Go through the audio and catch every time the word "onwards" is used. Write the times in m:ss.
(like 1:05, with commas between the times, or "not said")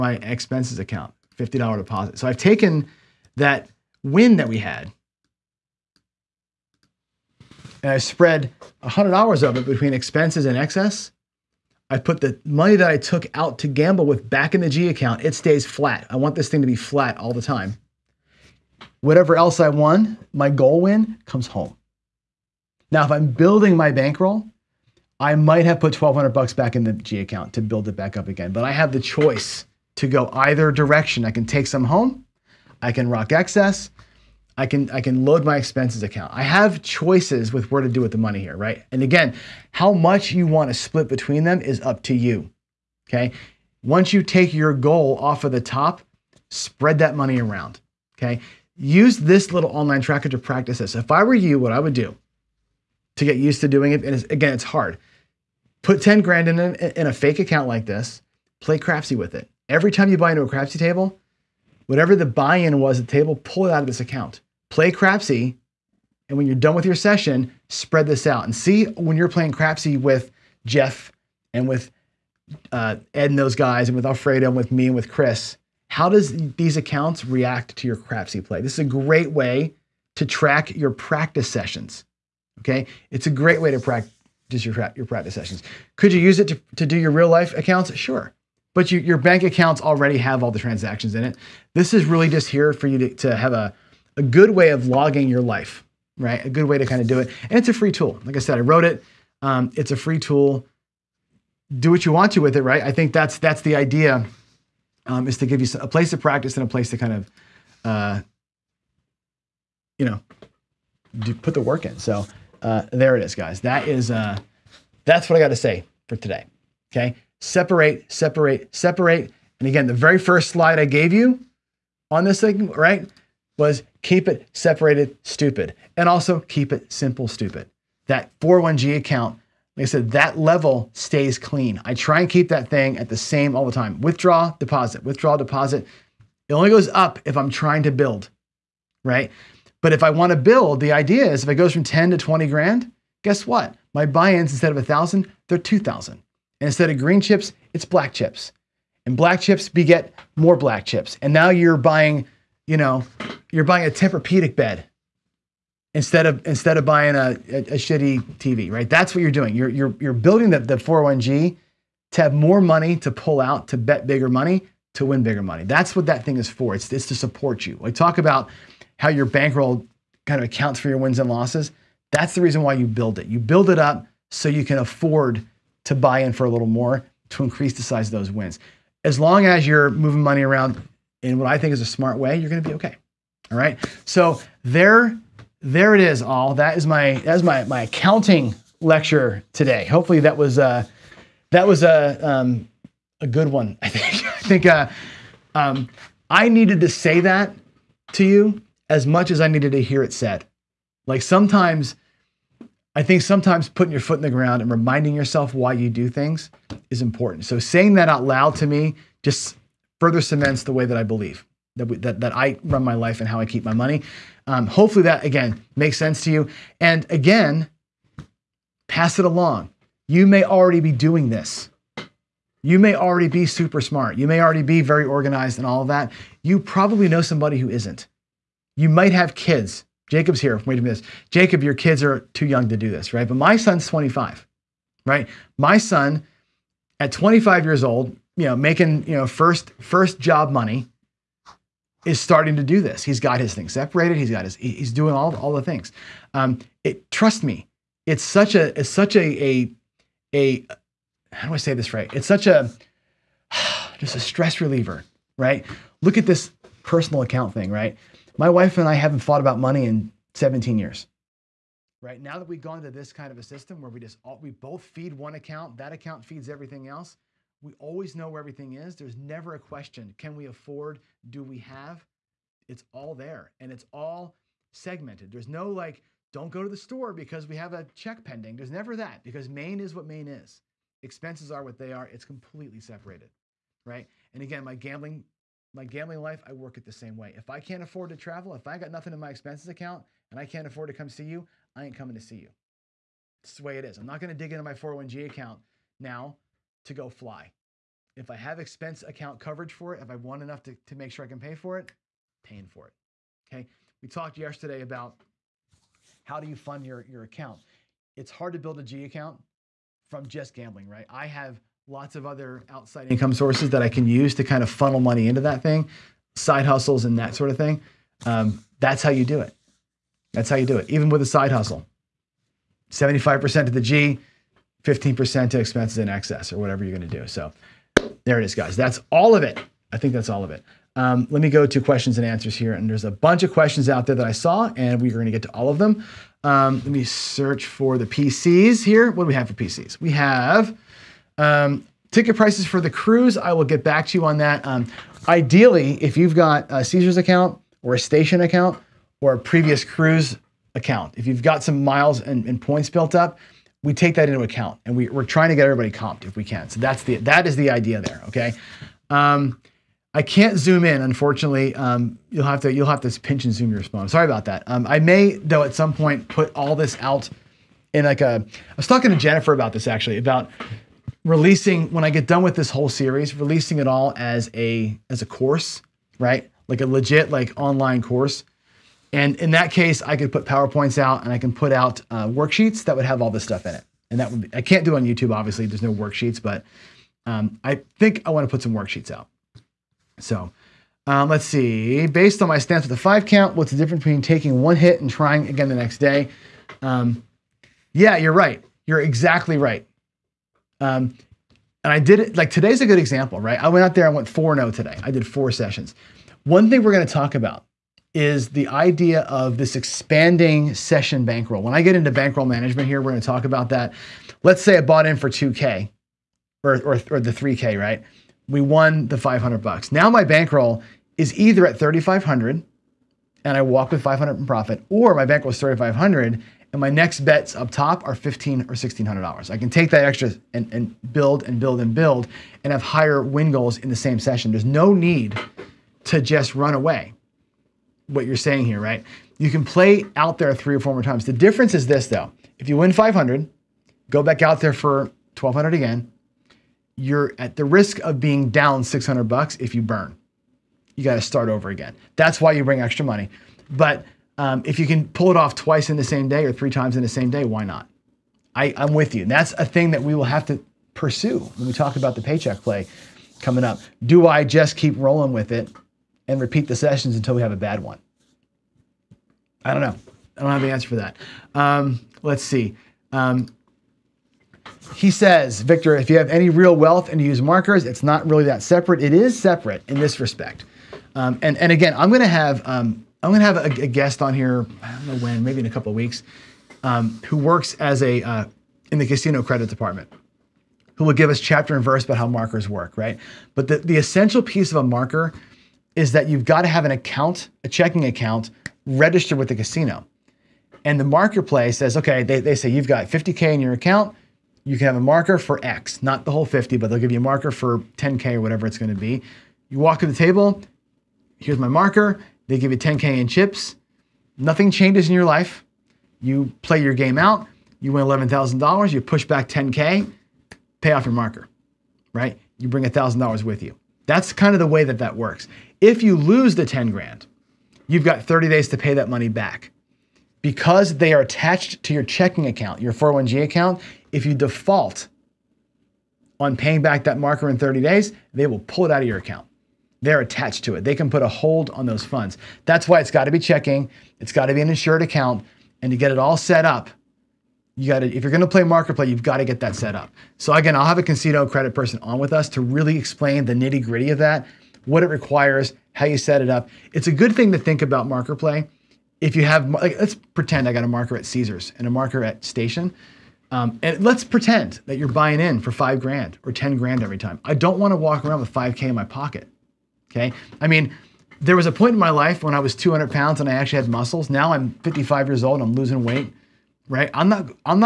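not said.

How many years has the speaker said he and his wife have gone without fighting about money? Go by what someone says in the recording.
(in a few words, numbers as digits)
17.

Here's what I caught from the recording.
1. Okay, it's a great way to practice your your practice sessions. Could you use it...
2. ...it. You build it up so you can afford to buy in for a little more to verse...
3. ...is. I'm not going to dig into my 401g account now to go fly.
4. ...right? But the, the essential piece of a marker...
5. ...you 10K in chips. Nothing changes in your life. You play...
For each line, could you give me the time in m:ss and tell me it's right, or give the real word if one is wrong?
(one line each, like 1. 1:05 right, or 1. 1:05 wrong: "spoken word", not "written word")
1. 1:22 right
2. 2:53 wrong: "increase", not "verse"
3. 4:53 right
4. 8:12 right
5. 8:32 right.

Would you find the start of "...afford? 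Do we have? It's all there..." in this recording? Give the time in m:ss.
4:30.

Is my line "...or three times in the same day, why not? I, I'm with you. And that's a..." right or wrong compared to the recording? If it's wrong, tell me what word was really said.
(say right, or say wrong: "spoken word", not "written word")
right.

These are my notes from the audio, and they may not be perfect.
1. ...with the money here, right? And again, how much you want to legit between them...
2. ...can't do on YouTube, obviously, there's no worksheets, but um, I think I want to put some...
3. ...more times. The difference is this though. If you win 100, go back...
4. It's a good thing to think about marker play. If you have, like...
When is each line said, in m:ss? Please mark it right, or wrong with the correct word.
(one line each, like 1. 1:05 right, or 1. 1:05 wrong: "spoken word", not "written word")
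1. 0:37 wrong: "split", not "legit"
2. 6:24 right
3. 7:20 wrong: "500", not "100"
4. 9:16 right.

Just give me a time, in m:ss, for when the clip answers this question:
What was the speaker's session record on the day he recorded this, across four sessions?
6:44.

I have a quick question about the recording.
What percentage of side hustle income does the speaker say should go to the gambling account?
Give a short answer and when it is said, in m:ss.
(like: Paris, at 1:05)
75%, at 5:22.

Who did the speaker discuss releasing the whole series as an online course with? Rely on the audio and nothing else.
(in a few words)
Jennifer.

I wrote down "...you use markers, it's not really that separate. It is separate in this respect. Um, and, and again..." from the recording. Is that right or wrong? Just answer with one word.
right.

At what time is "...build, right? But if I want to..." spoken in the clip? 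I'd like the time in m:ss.
2:17.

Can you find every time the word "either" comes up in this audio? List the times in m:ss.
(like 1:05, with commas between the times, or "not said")
0:30, 7:01.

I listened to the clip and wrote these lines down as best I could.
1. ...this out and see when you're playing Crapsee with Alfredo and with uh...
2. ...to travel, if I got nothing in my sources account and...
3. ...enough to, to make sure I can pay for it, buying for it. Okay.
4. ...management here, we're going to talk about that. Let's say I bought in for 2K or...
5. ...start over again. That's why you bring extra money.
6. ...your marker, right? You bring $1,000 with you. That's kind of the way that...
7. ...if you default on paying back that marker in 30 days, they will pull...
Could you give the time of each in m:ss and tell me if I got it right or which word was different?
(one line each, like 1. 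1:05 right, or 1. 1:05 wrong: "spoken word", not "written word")
1. 1:08 wrong: "Jeff", not "Alfredo"
2. 4:48 wrong: "expenses", not "sources"
3. 5:00 wrong: "paying", not "buying"
4. 6:52 right
5. 7:31 right
6. 8:41 right
7. 8:54 right.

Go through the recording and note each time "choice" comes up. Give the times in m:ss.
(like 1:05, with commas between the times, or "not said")
0:28, 0:36.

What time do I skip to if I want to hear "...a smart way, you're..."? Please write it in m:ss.
3:01.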